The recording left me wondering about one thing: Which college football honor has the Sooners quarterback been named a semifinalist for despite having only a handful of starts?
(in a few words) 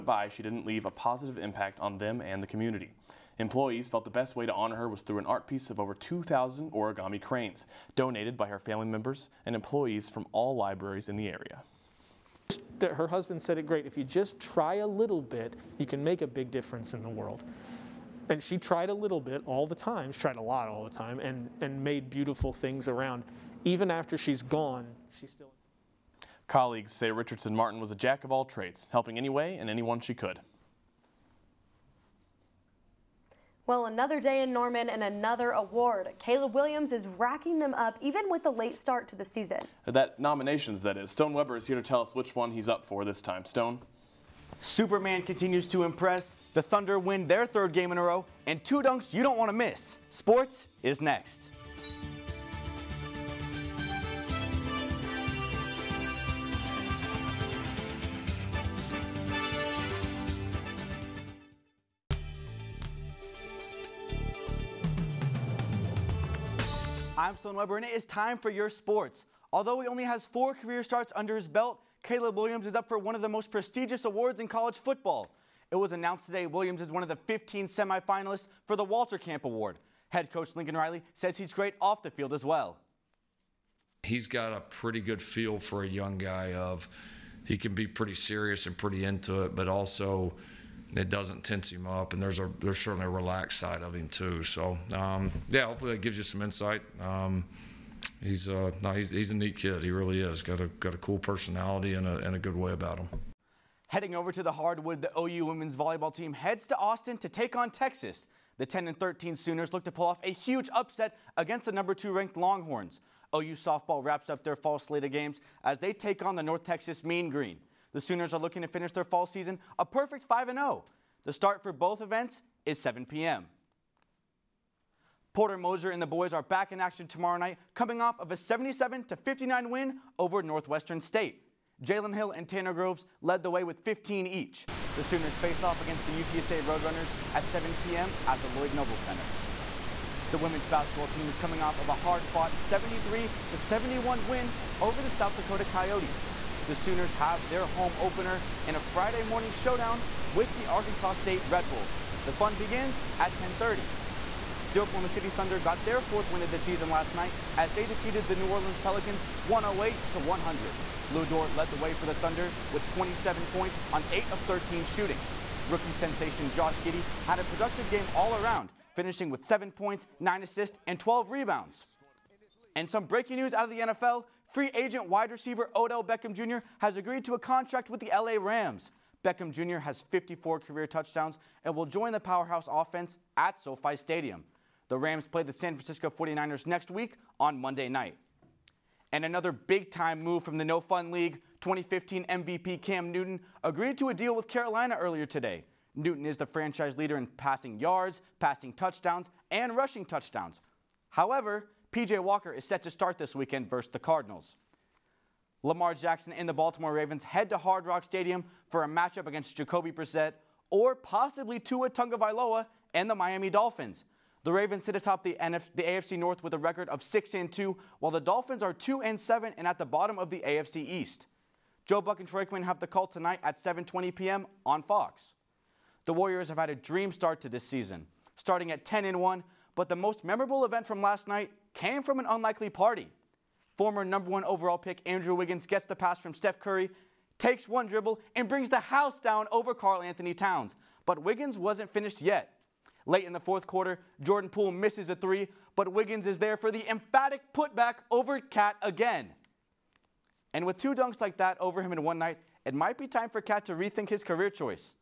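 Walter Camp Award.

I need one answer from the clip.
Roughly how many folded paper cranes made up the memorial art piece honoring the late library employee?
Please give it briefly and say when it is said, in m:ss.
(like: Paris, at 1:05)
2,000, at 0:05.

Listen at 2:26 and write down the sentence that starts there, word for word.
The Sooners have their home opener in a Friday morning showdown with the Arkansas State Red Wolves.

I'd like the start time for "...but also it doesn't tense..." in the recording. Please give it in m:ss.
1:29.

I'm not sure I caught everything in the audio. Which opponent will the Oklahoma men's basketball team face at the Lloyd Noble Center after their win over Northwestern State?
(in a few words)
UTSA Roadrunners.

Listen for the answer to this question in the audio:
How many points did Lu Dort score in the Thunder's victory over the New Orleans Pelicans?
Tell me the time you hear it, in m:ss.
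2:42.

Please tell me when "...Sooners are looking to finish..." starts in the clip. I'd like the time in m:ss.
1:58.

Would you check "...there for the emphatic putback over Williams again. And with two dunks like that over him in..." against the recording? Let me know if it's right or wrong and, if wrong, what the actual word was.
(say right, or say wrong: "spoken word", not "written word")
wrong: "KAT", not "Williams".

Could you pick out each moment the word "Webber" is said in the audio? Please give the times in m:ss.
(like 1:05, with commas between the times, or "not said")
0:41, 1:07.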